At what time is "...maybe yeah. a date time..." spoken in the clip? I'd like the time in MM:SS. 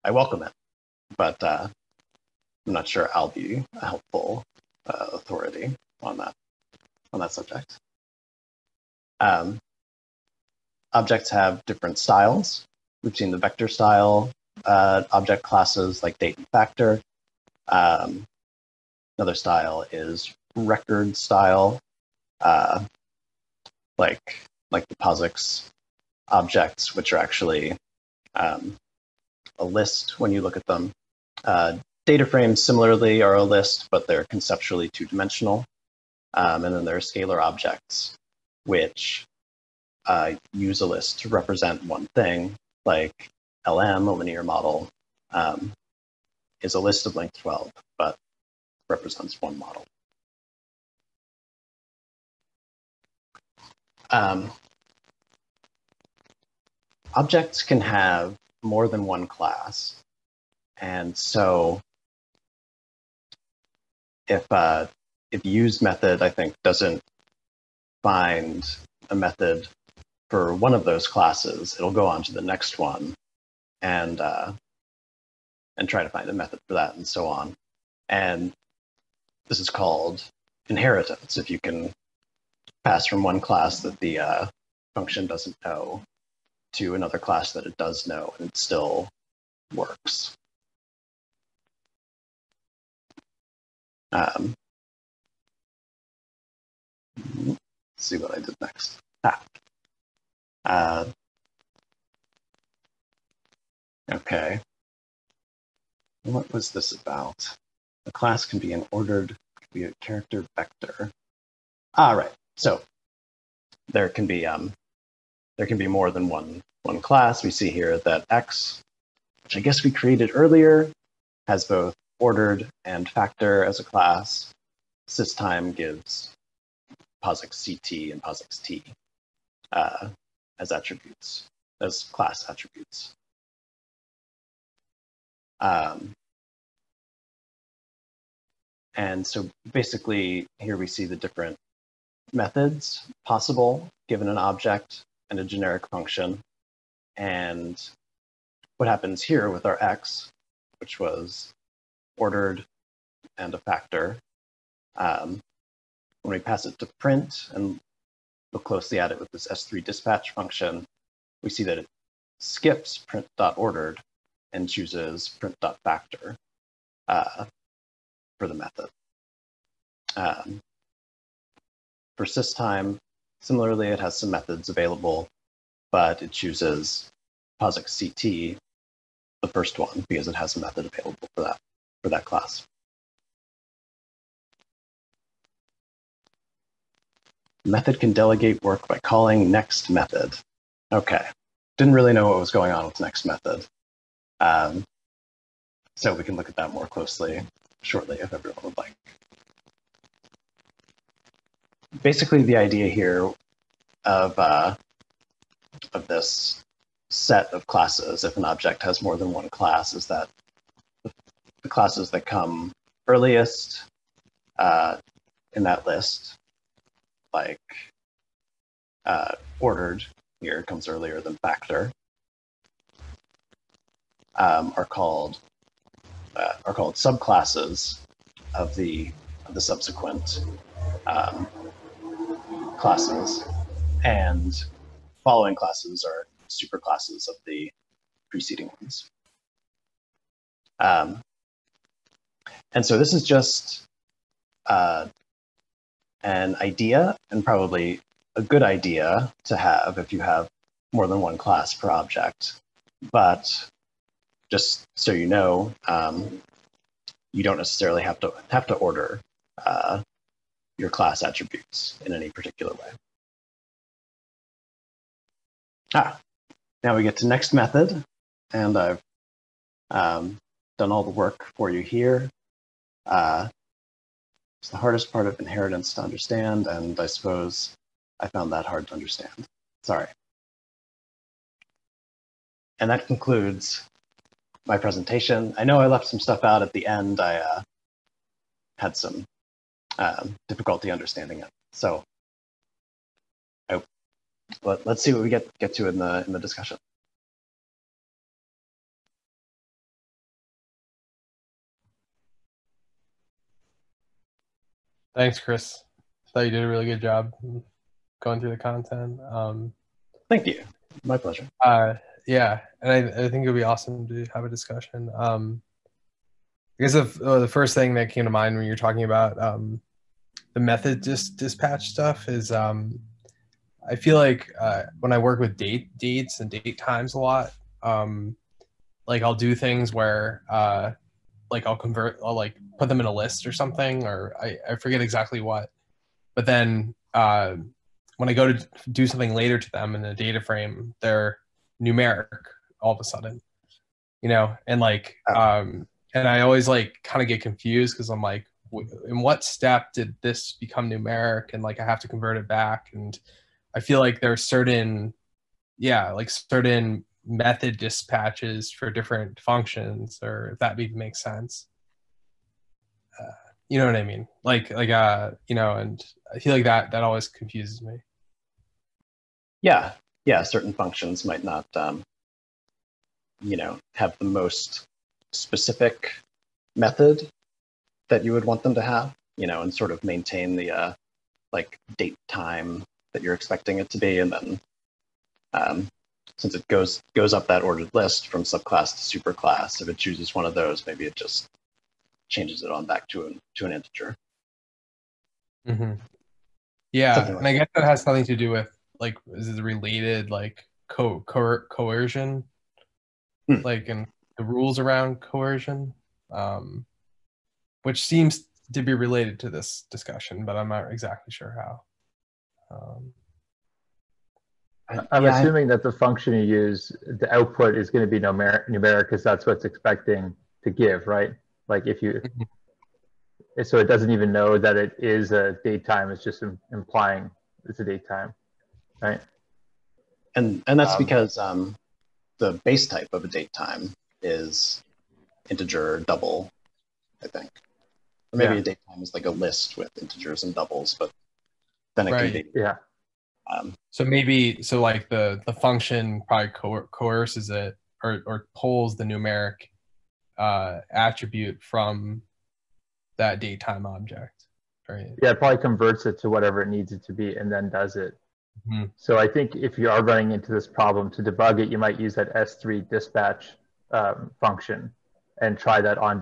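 07:18.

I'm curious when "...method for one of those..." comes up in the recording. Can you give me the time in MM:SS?
01:09.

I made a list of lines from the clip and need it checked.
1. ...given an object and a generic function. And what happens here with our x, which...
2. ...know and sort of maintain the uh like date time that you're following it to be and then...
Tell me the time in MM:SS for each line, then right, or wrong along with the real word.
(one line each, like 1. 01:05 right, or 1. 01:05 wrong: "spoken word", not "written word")
1. 02:24 right
2. 06:19 wrong: "expecting", not "following".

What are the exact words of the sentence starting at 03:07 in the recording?
Method can delegate work by calling next method.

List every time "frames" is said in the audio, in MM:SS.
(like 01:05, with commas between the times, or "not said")
00:32, 05:40.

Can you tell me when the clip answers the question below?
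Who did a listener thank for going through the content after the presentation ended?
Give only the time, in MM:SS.
05:05.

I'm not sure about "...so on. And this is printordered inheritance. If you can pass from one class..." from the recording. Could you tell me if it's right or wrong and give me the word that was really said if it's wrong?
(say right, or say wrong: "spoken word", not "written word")
wrong: "called", not "printordered".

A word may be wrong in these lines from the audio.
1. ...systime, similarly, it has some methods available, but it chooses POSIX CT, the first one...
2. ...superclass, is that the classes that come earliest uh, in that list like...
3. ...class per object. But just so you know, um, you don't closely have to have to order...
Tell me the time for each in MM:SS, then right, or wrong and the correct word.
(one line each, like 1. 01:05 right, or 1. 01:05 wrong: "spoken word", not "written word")
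1. 02:52 right
2. 03:29 wrong: "class", not "superclass"
3. 04:11 wrong: "necessarily", not "closely".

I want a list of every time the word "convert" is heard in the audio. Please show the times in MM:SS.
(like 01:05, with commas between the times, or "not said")
05:31, 05:52, 07:35.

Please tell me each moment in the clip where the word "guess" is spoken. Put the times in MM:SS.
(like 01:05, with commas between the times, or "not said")
01:59, 05:16, 06:37.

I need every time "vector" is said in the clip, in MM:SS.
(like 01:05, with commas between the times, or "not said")
00:13, 01:50.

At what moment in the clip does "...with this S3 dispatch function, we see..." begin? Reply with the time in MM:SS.
02:39.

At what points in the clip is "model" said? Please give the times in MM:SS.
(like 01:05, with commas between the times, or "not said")
00:44, 00:49.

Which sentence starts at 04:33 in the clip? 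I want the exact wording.
Uh, it's the hardest part of inheritance to understand, and I suppose I found that hard to understand.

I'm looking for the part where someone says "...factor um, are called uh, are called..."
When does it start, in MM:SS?
03:41.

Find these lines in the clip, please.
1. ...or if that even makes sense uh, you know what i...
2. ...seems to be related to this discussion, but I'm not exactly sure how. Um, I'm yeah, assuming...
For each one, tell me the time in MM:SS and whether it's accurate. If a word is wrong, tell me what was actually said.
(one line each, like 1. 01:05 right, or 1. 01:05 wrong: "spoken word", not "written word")
1. 06:00 right
2. 06:48 right.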